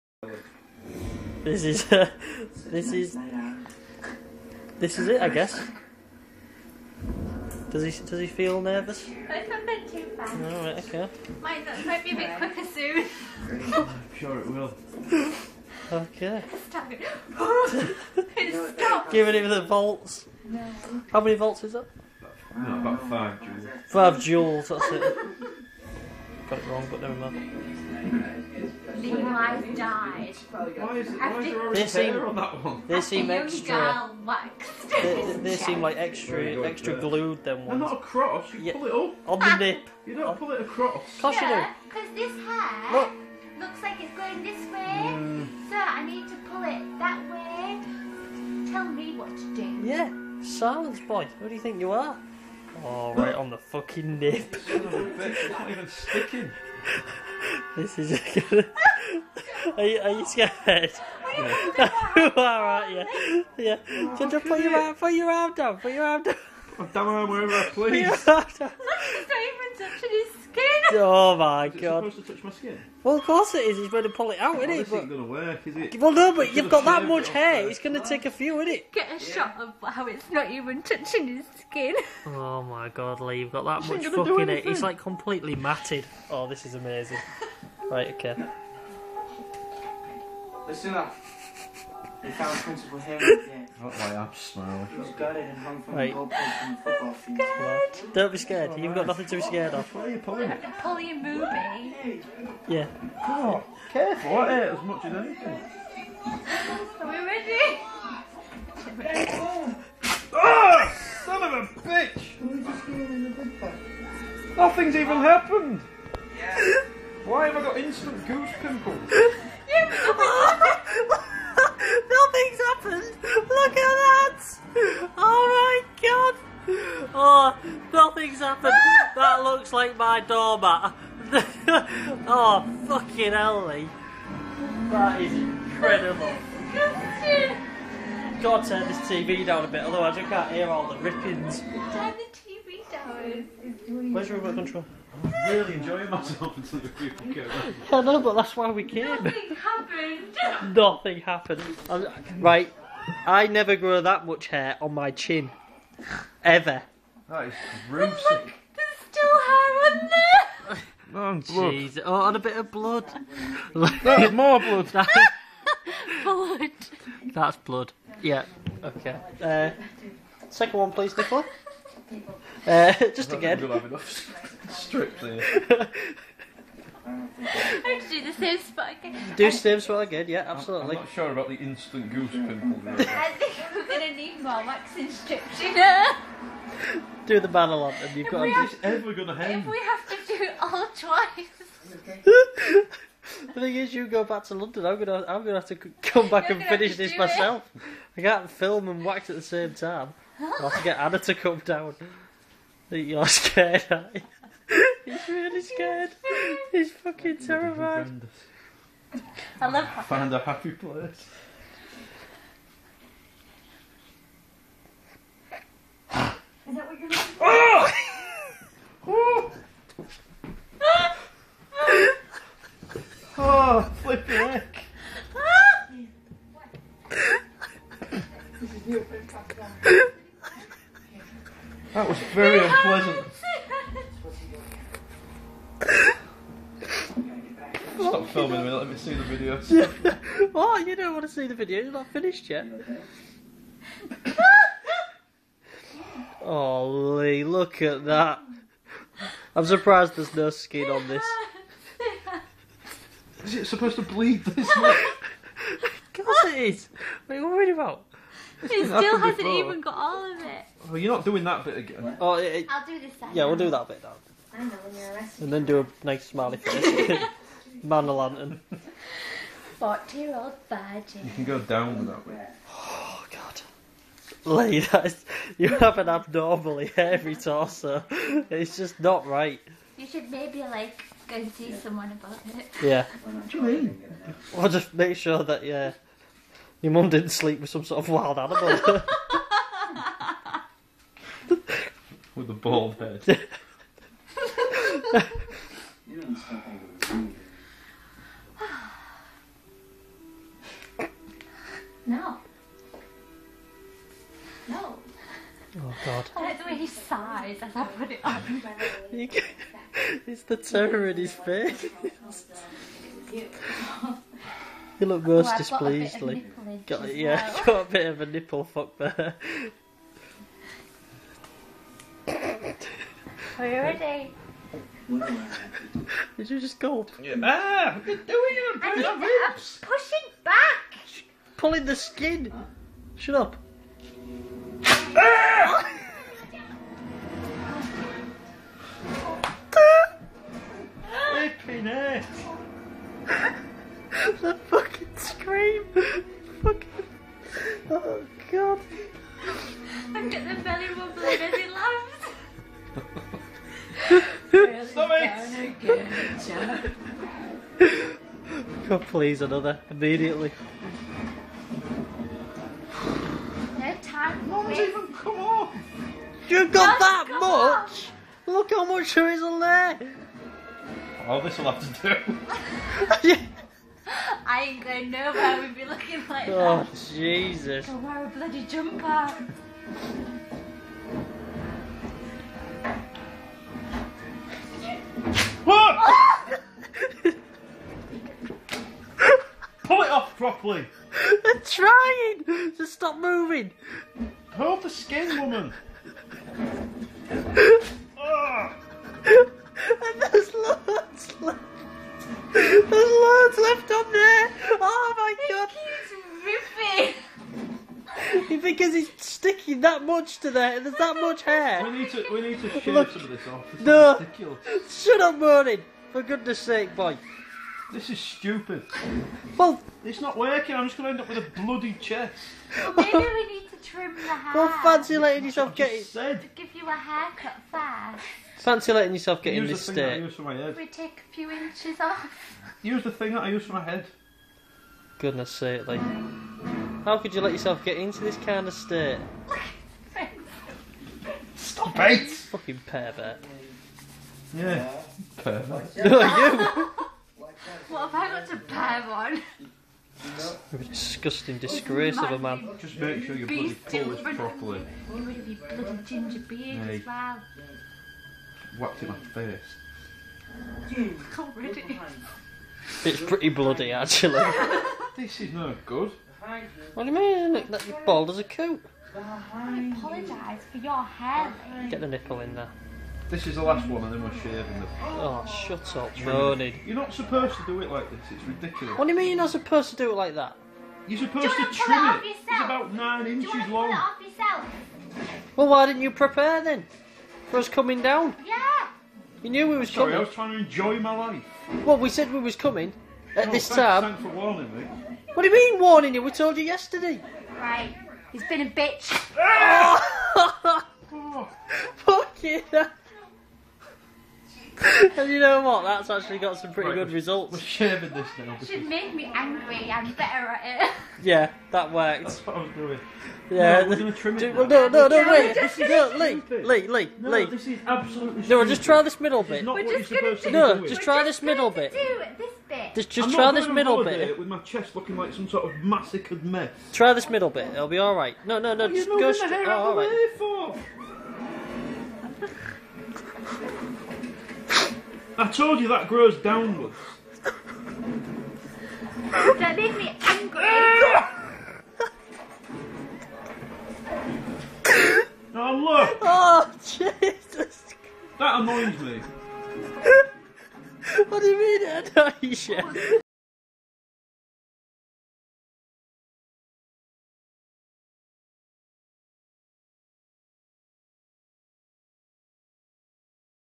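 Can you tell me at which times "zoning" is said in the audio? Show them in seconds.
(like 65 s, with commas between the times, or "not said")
not said.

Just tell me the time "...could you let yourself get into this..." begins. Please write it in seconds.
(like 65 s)
437 s.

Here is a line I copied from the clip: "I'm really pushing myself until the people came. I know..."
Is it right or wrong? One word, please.
wrong.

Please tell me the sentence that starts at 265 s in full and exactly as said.
And then do a nice smiley face.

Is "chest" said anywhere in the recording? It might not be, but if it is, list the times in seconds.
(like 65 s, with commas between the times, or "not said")
421 s, 524 s.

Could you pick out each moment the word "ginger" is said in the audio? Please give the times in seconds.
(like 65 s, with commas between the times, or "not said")
64 s, 456 s.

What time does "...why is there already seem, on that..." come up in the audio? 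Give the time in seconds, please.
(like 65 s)
30 s.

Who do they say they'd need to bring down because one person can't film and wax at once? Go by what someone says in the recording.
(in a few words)
Anna.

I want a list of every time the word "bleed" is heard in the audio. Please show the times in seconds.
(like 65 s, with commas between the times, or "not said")
254 s.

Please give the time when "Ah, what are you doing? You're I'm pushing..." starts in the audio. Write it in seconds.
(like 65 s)
327 s.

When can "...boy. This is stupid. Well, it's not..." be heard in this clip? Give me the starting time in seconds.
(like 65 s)
416 s.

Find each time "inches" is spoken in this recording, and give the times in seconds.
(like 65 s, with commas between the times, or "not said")
431 s, 483 s.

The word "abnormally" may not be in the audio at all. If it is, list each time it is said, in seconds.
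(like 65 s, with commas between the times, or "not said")
276 s.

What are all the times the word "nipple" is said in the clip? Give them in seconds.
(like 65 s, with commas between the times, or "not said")
318 s, 472 s.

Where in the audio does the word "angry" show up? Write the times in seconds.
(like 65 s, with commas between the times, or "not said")
509 s, 540 s.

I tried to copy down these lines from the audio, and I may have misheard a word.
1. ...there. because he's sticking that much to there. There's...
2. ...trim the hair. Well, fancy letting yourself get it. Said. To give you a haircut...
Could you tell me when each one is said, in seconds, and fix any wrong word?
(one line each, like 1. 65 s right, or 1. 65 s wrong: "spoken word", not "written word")
1. 404 s right
2. 423 s right.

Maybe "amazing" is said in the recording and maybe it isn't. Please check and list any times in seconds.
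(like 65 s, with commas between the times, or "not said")
86 s.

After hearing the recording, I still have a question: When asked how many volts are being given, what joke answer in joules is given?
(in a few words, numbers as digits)
5 joules.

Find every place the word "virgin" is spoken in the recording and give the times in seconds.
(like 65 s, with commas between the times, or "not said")
270 s.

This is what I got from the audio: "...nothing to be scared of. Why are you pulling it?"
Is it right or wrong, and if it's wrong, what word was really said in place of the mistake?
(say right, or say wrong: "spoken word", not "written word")
right.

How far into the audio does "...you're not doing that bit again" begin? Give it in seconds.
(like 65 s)
260 s.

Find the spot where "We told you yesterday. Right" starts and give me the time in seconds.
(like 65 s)
496 s.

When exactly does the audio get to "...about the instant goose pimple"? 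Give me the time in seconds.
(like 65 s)
181 s.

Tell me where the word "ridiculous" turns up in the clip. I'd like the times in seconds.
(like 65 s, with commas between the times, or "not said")
414 s, 478 s.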